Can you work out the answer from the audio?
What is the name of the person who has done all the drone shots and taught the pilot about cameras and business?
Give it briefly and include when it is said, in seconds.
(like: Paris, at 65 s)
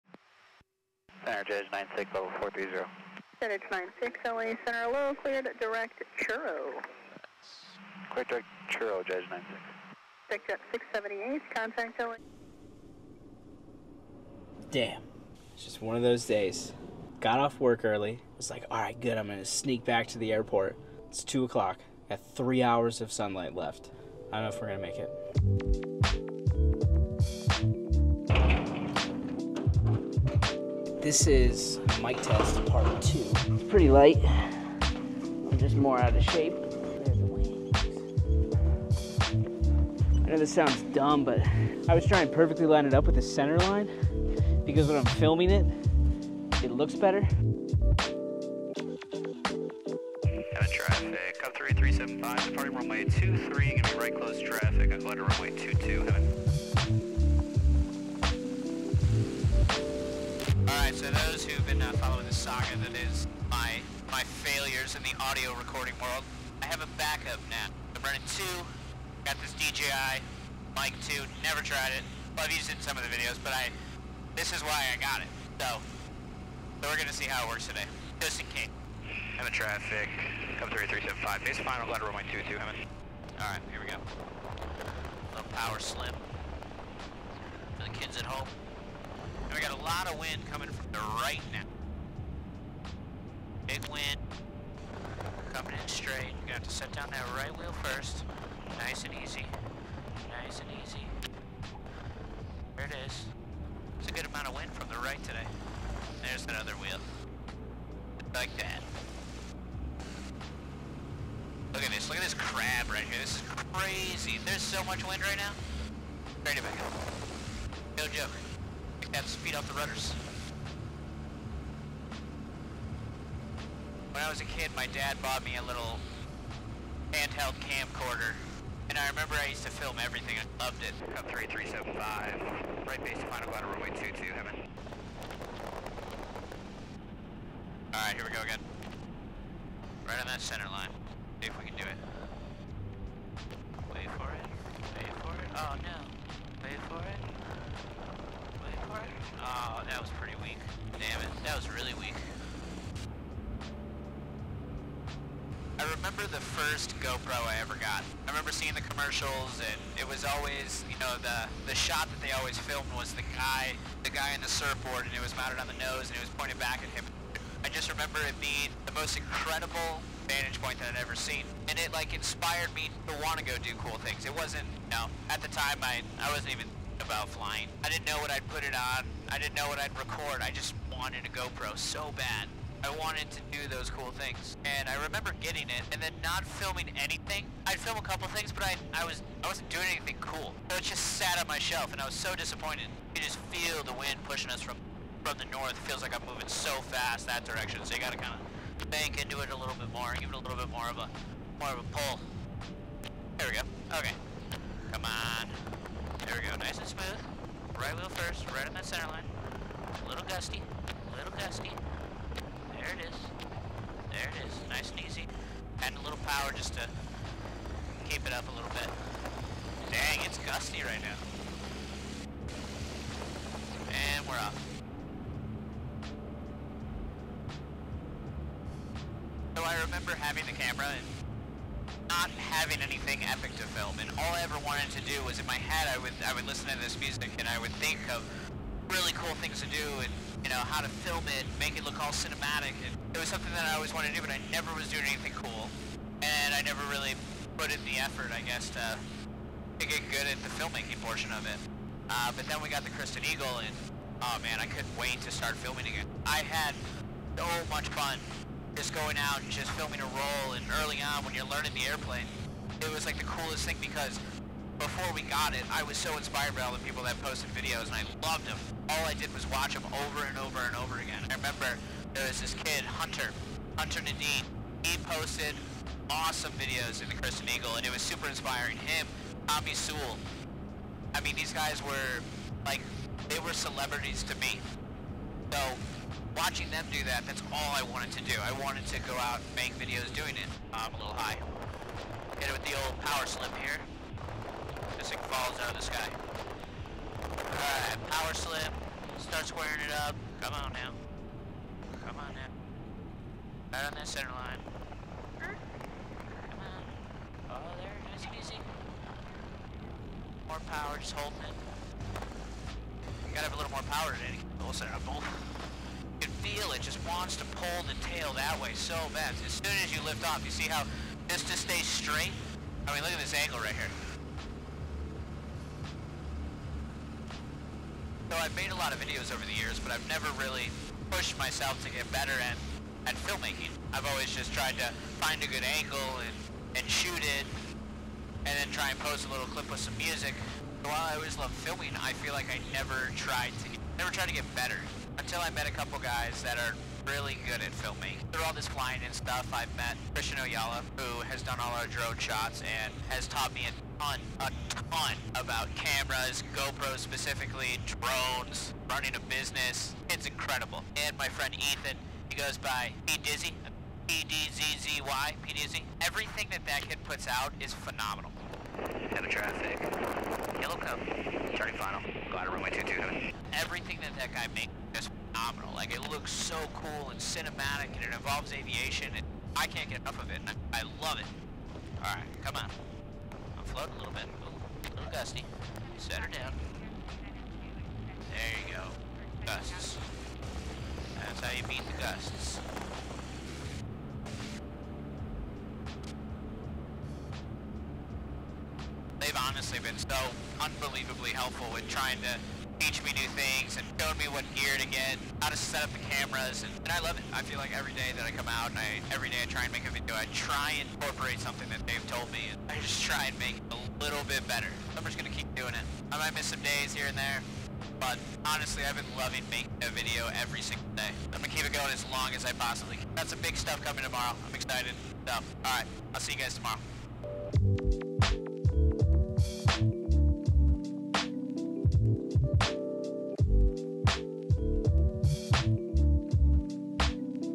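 Christian Oyala, at 350 s.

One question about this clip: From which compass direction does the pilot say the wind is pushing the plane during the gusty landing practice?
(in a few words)
north.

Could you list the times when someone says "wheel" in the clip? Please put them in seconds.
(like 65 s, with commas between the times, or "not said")
97 s, 106 s, 207 s.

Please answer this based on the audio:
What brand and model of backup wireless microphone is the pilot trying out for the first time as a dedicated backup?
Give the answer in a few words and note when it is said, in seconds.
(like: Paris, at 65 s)
DJI Mic 2, at 69 s.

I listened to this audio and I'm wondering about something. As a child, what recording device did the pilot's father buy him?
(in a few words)
handheld camcorder.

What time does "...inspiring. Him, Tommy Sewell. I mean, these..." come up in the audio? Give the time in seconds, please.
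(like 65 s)
278 s.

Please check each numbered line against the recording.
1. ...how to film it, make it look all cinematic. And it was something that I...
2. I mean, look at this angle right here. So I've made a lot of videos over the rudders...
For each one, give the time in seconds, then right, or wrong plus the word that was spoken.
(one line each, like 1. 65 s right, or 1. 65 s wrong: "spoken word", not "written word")
1. 240 s right
2. 322 s wrong: "years", not "rudders".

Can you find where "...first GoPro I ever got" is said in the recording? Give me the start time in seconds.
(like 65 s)
156 s.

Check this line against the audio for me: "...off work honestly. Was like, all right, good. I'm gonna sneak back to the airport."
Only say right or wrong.
wrong.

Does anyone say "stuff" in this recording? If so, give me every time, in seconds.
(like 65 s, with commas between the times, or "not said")
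349 s, 423 s.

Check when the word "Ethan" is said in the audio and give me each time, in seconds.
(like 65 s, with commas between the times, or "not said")
361 s.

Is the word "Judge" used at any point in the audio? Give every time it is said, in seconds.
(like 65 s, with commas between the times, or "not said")
1 s, 9 s.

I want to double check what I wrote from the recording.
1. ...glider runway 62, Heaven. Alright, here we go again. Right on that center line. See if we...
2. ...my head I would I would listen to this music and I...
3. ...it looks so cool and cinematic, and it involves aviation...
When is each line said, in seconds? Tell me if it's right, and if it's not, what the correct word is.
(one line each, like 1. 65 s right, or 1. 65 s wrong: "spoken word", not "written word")
1. 133 s wrong: "22", not "62"
2. 235 s right
3. 375 s right.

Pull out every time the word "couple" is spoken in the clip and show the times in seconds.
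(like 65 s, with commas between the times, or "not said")
188 s, 345 s.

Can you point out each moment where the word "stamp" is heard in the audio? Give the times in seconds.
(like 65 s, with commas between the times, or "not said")
not said.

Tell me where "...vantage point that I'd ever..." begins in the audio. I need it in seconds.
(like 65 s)
170 s.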